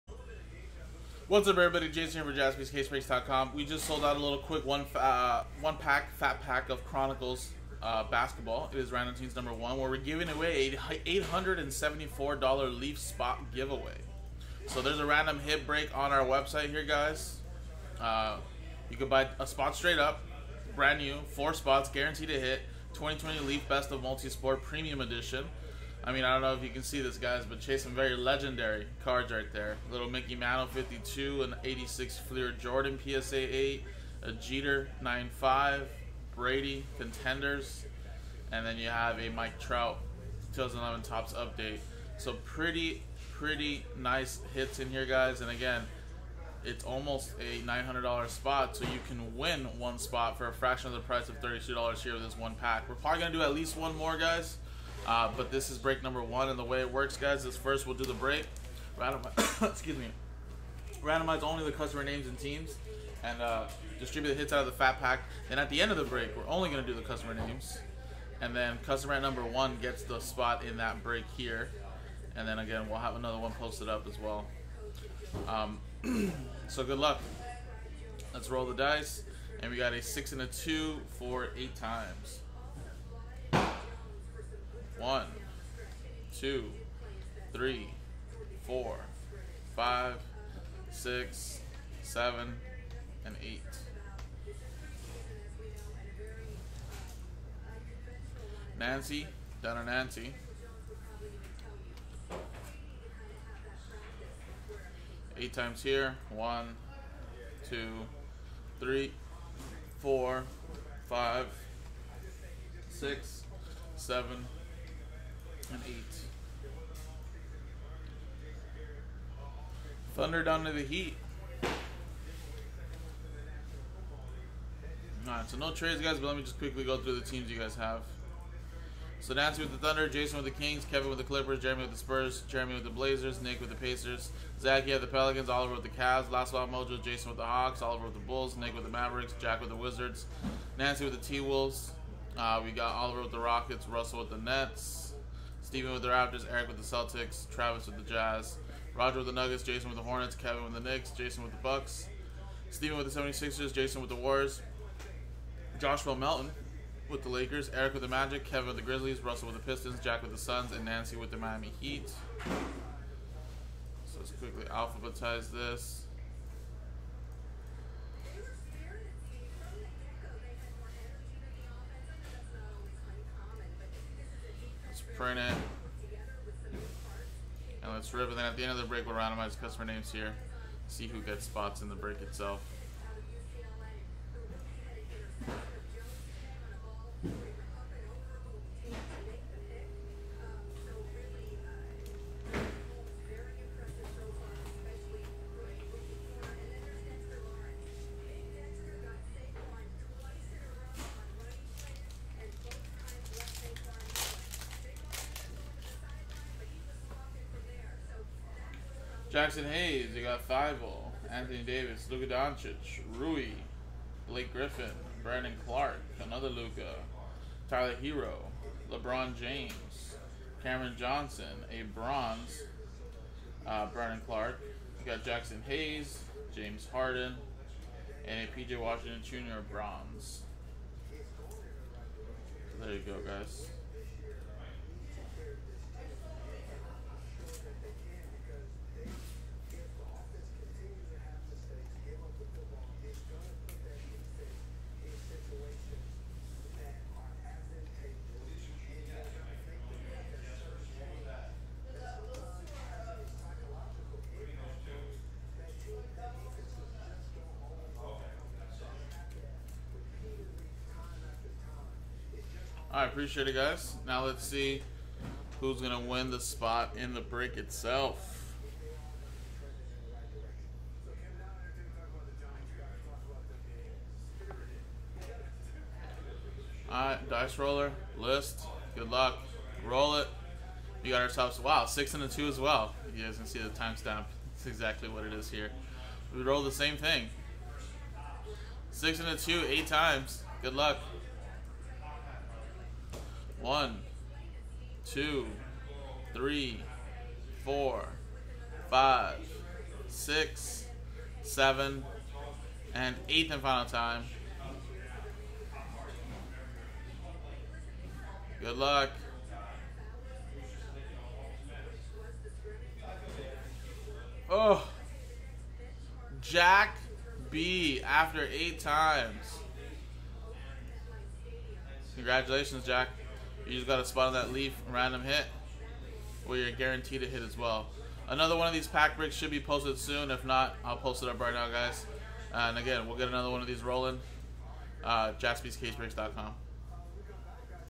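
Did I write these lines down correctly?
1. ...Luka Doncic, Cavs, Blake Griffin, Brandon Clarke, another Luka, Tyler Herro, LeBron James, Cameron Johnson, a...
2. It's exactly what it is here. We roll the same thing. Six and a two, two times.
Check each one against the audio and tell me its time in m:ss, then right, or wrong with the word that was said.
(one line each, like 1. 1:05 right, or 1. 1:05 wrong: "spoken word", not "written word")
1. 3:32 wrong: "Rui", not "Cavs"
2. 4:44 wrong: "eight", not "two".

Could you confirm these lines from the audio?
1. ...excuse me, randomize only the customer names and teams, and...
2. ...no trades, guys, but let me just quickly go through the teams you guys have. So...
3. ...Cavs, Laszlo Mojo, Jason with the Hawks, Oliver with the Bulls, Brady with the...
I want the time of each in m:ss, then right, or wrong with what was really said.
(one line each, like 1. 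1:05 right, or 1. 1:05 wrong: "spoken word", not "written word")
1. 0:59 right
2. 2:05 right
3. 2:15 wrong: "Nick", not "Brady".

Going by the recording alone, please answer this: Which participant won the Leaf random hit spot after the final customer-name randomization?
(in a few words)
Jack B.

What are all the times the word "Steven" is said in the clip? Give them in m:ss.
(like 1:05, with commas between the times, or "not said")
2:25, 2:32.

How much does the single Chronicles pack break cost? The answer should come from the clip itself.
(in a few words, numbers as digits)
$32.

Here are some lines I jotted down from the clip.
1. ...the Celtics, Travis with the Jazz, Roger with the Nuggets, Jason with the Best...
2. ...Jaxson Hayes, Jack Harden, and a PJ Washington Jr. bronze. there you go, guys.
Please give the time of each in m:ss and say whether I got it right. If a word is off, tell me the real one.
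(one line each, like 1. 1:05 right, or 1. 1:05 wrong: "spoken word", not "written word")
1. 2:26 wrong: "Hornets", not "Best"
2. 3:45 wrong: "James", not "Jack".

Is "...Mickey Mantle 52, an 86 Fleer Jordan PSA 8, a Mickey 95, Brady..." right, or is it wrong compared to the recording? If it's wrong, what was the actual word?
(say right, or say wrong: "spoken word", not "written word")
wrong: "Jeter", not "Mickey".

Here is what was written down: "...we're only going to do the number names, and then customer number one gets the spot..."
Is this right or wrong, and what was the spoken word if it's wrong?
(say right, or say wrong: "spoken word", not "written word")
wrong: "customer", not "number".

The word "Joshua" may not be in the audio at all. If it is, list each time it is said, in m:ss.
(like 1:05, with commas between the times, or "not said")
2:35.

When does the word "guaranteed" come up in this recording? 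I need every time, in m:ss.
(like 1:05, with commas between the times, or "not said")
0:21, 5:26.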